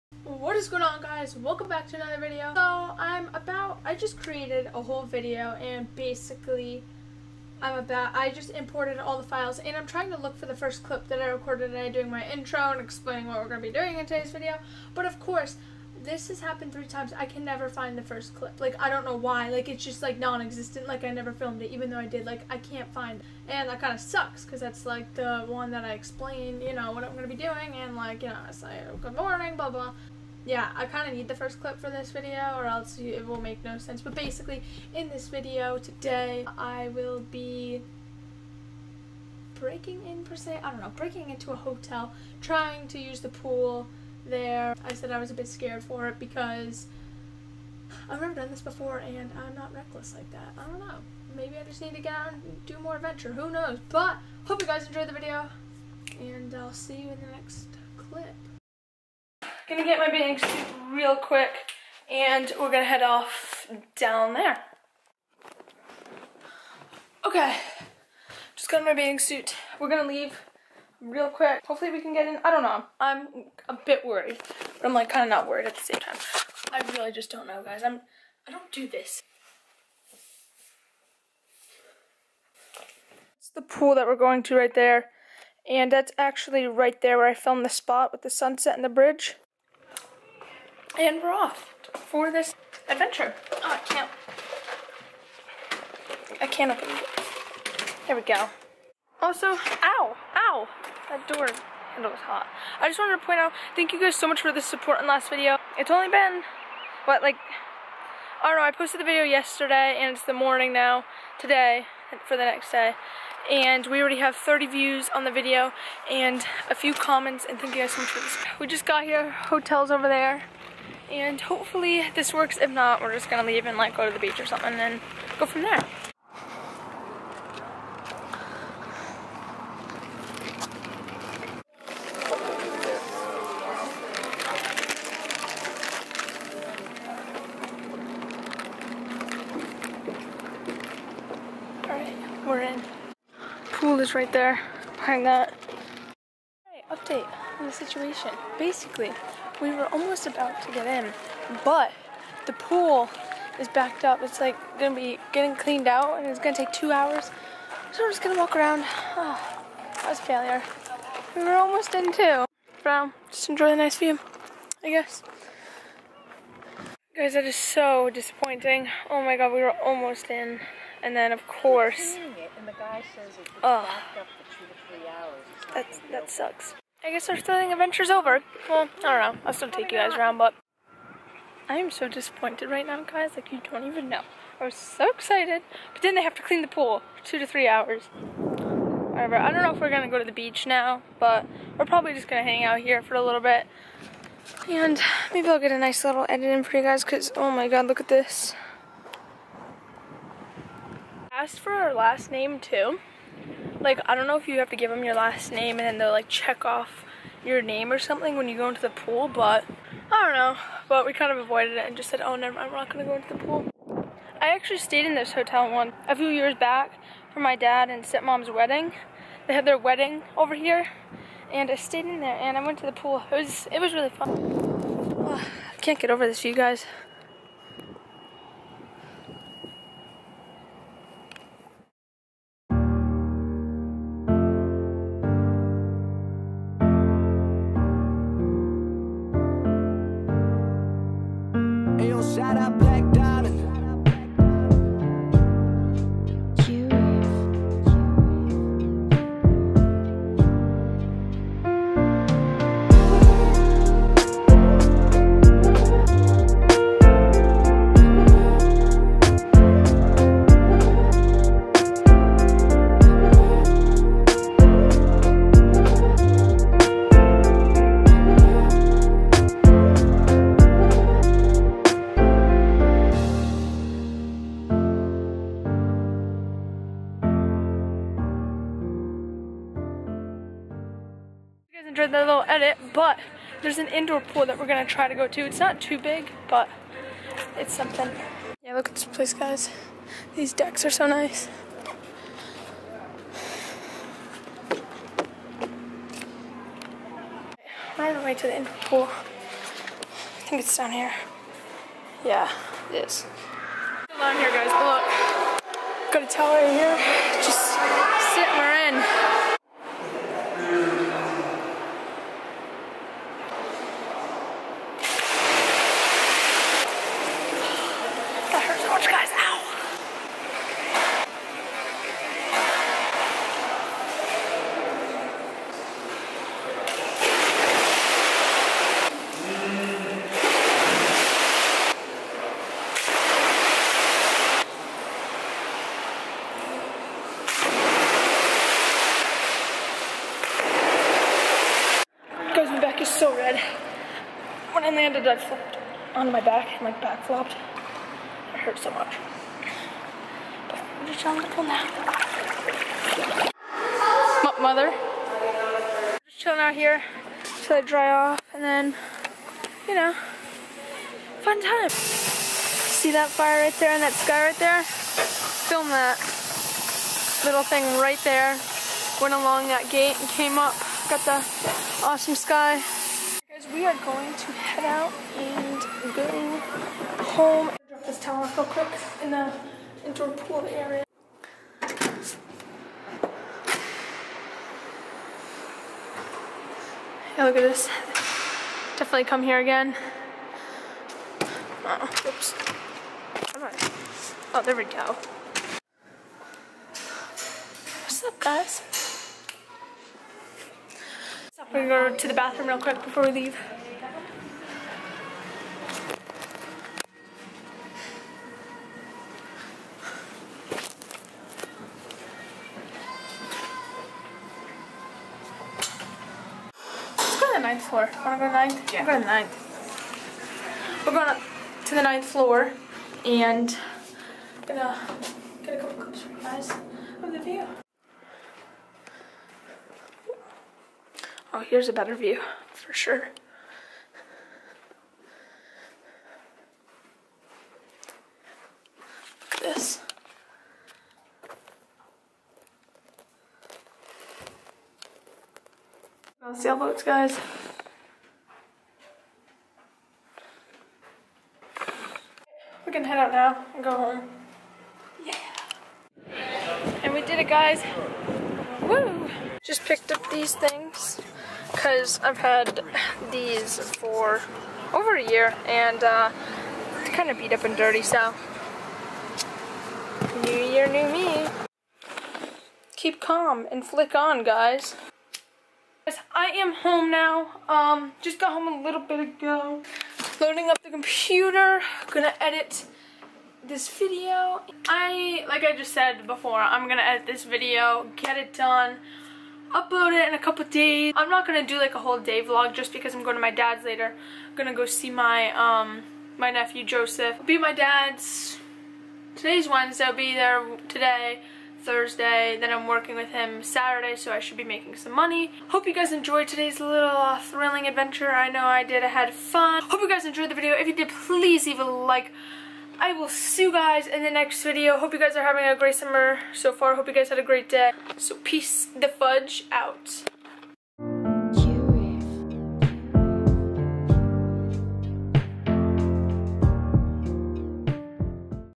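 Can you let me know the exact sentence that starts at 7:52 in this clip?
Keep calm and flick on, guys.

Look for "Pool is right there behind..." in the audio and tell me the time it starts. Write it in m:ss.
2:23.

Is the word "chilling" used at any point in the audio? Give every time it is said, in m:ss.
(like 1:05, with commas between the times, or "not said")
5:51, 5:56.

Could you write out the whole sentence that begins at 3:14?
And maybe I'll get a nice little edit in for you guys, because, oh my god, look at this.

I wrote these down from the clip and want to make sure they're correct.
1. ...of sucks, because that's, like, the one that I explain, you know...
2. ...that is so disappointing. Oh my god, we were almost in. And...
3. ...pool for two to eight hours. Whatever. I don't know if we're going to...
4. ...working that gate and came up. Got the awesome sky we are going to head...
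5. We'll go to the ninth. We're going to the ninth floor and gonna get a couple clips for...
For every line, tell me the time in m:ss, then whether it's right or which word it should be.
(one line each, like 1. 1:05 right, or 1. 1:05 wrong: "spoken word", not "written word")
1. 0:23 right
2. 2:47 right
3. 3:06 wrong: "three", not "eight"
4. 6:09 wrong: "along", not "working"
5. 6:59 right.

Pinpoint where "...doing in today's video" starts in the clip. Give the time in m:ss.
0:13.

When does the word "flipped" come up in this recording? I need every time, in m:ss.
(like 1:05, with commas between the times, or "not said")
5:45.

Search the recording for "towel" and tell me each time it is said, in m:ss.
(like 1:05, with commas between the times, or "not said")
5:06, 6:18.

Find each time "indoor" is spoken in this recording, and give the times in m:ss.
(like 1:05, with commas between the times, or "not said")
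4:43, 4:58, 6:20.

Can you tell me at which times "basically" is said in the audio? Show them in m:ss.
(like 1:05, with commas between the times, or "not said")
0:05, 0:34, 2:28.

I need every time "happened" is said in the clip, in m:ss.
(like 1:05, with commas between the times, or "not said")
0:16.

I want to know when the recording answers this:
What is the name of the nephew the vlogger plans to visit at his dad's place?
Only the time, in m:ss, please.
8:16.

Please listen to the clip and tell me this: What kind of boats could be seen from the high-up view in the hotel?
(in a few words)
sailboats.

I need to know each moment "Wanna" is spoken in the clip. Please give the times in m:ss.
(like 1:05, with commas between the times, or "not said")
6:58.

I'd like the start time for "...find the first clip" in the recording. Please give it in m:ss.
0:17.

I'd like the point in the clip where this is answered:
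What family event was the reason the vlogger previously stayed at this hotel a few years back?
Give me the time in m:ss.
3:37.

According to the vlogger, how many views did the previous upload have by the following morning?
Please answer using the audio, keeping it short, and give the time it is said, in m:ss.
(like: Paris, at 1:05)
30, at 1:54.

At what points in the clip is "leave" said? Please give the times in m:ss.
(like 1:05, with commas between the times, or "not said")
1:10, 2:03, 6:43, 8:31.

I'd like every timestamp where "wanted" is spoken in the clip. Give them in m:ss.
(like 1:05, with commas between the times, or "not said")
1:42.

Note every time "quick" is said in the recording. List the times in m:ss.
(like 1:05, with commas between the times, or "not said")
1:01, 1:11, 6:18, 6:42.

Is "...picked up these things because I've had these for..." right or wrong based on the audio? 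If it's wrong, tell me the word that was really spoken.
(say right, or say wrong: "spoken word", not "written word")
right.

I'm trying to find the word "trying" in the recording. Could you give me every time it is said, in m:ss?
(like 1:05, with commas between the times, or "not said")
0:09, 0:42.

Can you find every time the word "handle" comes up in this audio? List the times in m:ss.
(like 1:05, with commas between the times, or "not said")
1:41.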